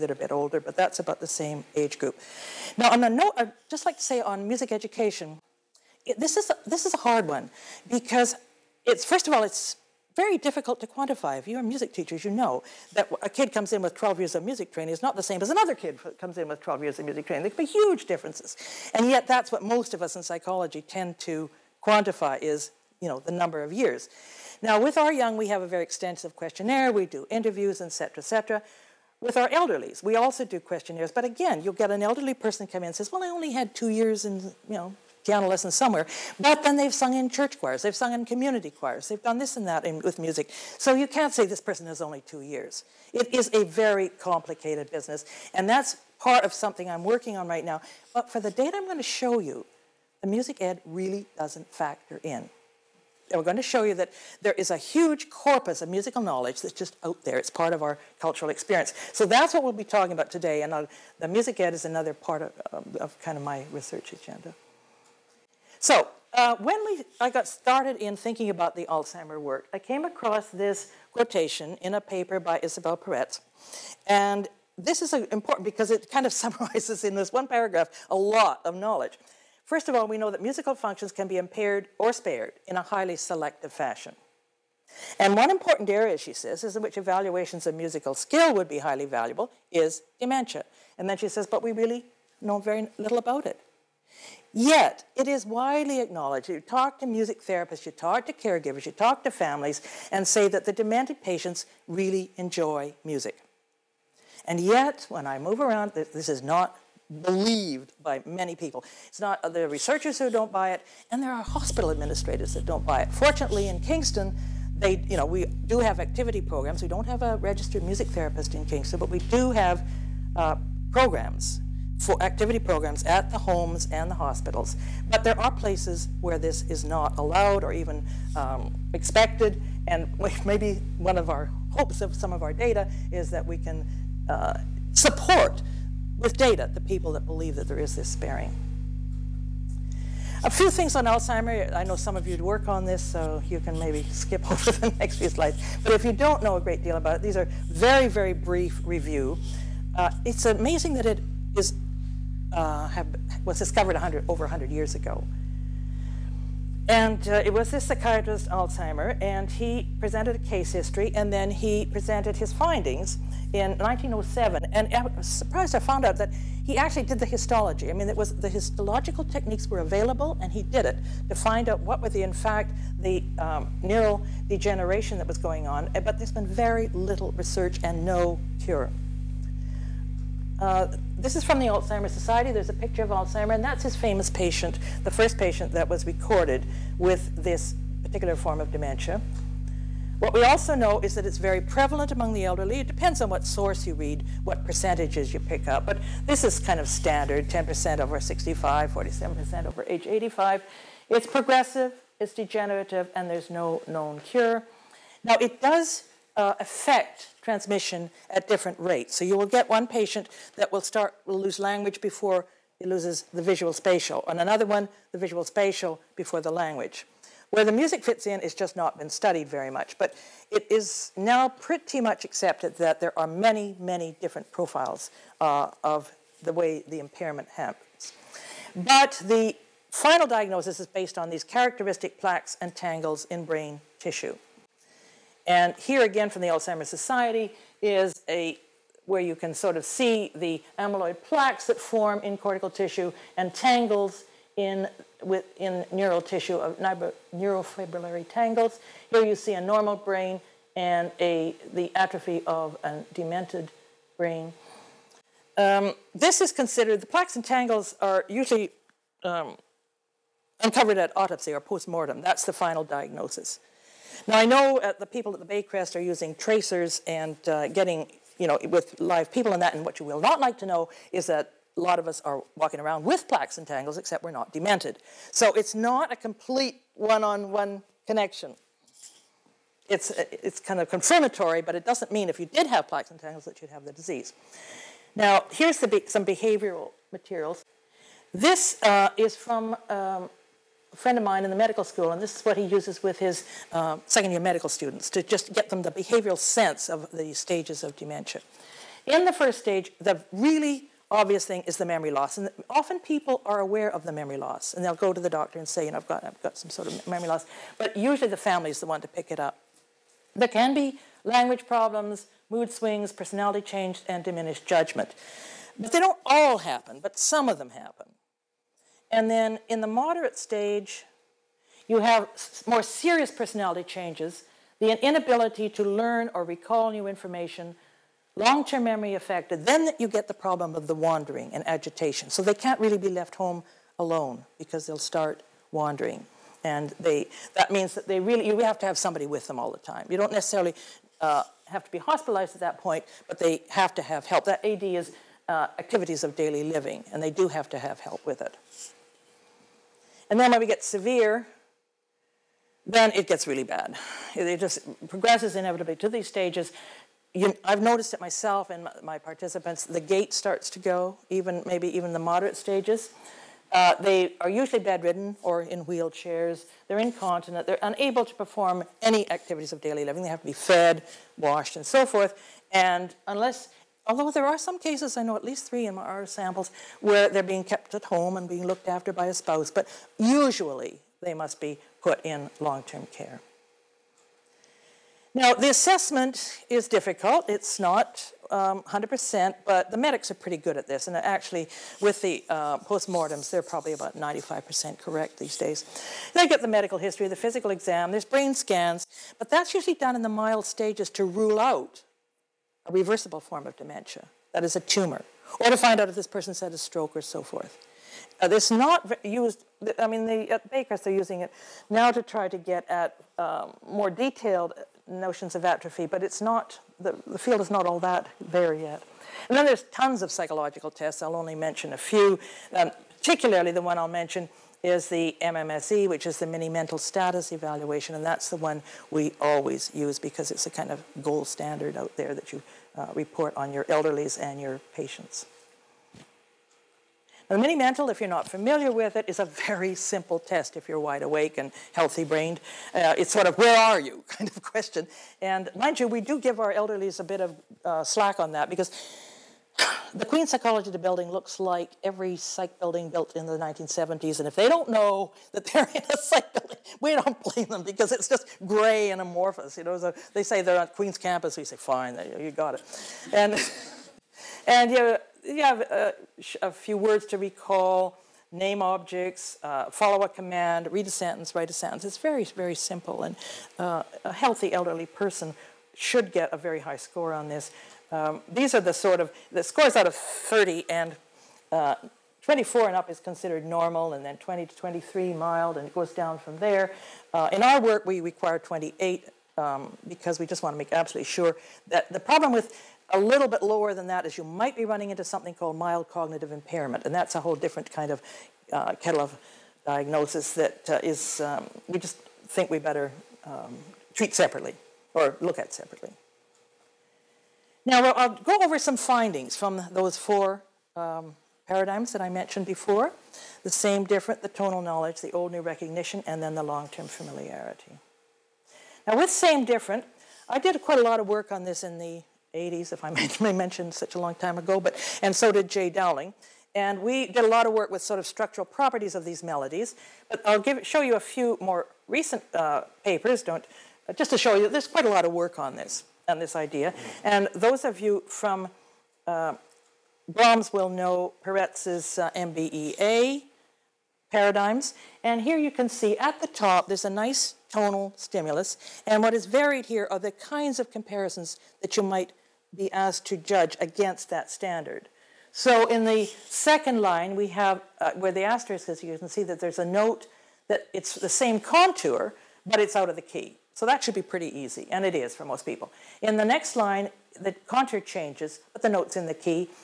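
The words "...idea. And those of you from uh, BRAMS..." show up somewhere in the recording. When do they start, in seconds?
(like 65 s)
536 s.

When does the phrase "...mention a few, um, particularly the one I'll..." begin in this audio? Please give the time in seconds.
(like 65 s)
421 s.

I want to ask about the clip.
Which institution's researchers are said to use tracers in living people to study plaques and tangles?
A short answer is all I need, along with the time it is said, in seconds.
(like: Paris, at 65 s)
Baycrest, at 265 s.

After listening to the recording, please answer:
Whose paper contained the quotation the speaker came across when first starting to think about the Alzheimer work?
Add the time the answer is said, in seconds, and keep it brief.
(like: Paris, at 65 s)
Isabelle Peretz, at 72 s.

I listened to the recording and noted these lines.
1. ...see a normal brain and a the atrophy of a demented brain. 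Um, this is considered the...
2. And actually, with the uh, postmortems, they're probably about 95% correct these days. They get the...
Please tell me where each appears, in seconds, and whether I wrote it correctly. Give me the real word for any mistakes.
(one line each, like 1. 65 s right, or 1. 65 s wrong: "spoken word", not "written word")
1. 249 s right
2. 391 s right.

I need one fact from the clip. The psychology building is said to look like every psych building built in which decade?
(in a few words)
1970s.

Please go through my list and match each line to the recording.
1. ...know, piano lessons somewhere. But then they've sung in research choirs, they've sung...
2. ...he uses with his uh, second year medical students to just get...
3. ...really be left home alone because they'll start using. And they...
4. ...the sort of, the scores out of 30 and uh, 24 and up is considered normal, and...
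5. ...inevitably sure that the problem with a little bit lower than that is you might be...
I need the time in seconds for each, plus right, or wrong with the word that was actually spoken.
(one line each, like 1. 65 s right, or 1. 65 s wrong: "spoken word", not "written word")
1. 34 s wrong: "church", not "research"
2. 292 s right
3. 332 s wrong: "wandering", not "using"
4. 478 s right
5. 490 s wrong: "absolutely", not "inevitably".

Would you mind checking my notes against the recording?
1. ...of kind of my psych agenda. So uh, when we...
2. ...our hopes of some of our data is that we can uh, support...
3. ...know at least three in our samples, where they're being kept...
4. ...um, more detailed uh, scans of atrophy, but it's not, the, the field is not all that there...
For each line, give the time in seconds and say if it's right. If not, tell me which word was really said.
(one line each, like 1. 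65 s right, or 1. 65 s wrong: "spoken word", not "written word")
1. 62 s wrong: "research", not "psych"
2. 131 s right
3. 375 s right
4. 413 s wrong: "notions", not "scans".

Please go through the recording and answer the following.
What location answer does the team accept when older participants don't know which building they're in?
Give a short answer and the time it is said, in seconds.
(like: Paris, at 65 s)
Queen's campus, at 460 s.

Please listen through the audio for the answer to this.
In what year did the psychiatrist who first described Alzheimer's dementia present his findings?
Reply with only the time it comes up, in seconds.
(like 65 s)
163 s.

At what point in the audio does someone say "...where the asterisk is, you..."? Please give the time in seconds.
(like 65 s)
558 s.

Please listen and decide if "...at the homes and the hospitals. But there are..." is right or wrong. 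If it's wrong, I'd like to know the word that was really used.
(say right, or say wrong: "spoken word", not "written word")
right.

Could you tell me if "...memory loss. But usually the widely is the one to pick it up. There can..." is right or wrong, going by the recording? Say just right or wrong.
wrong.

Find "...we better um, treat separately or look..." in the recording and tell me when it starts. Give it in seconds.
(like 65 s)
502 s.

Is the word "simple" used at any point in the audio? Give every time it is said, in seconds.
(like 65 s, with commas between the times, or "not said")
439 s, 472 s.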